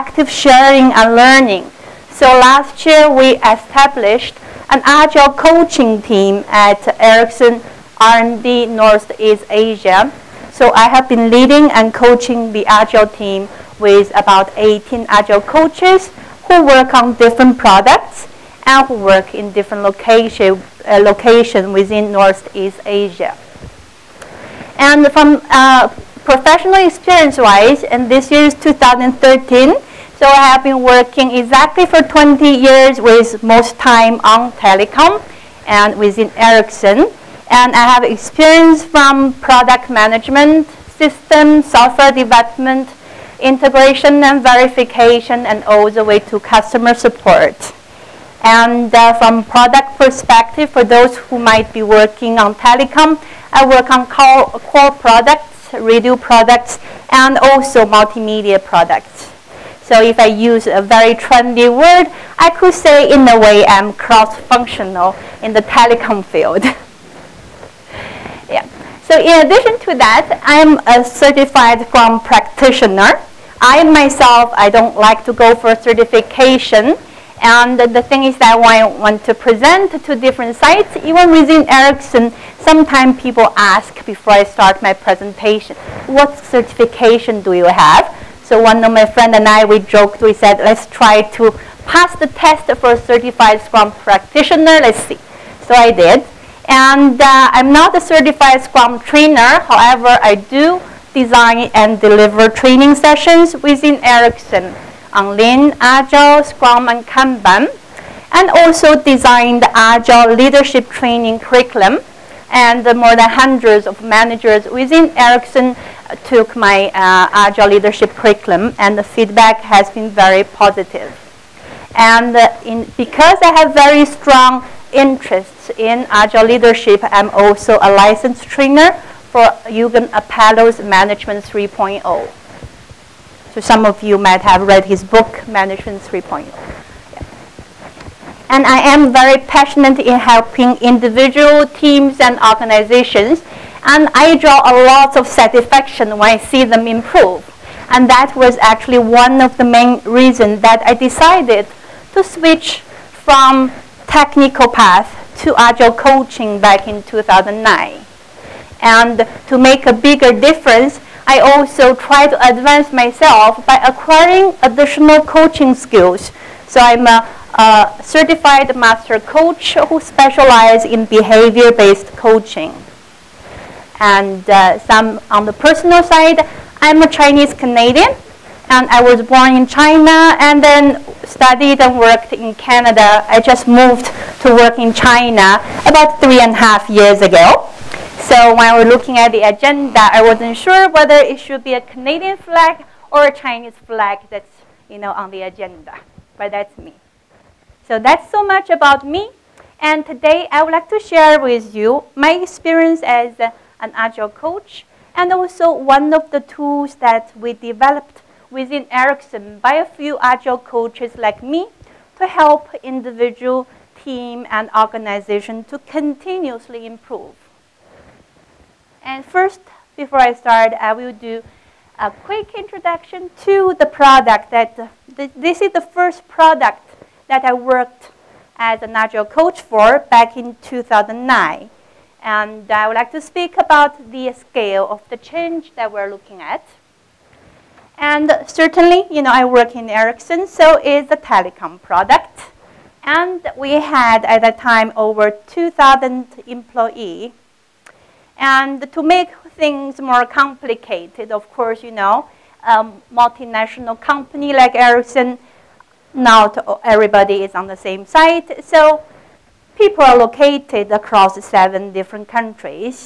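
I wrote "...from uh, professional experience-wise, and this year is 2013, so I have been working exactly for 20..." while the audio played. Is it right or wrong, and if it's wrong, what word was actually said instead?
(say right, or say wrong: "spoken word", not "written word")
right.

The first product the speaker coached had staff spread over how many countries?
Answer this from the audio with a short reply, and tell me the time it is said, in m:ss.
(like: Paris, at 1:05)
7, at 4:21.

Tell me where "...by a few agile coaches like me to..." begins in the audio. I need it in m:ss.
3:29.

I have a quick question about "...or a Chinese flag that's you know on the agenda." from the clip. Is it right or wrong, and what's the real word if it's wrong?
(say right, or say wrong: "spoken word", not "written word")
right.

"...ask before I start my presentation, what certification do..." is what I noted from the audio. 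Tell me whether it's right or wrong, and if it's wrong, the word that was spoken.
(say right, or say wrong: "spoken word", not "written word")
right.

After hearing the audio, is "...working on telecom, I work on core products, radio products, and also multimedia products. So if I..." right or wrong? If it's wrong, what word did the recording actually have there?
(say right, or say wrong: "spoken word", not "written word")
right.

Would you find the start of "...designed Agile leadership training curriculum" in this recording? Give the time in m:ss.
1:49.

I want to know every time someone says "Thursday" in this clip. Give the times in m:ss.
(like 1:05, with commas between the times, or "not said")
not said.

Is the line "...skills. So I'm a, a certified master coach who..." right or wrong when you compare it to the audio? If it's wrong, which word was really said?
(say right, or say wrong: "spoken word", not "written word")
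right.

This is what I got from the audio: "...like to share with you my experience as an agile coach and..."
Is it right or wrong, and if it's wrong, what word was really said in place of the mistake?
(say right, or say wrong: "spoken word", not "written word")
right.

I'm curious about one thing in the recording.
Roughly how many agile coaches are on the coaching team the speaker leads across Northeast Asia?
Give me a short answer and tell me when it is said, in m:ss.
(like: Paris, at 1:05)
18, at 0:14.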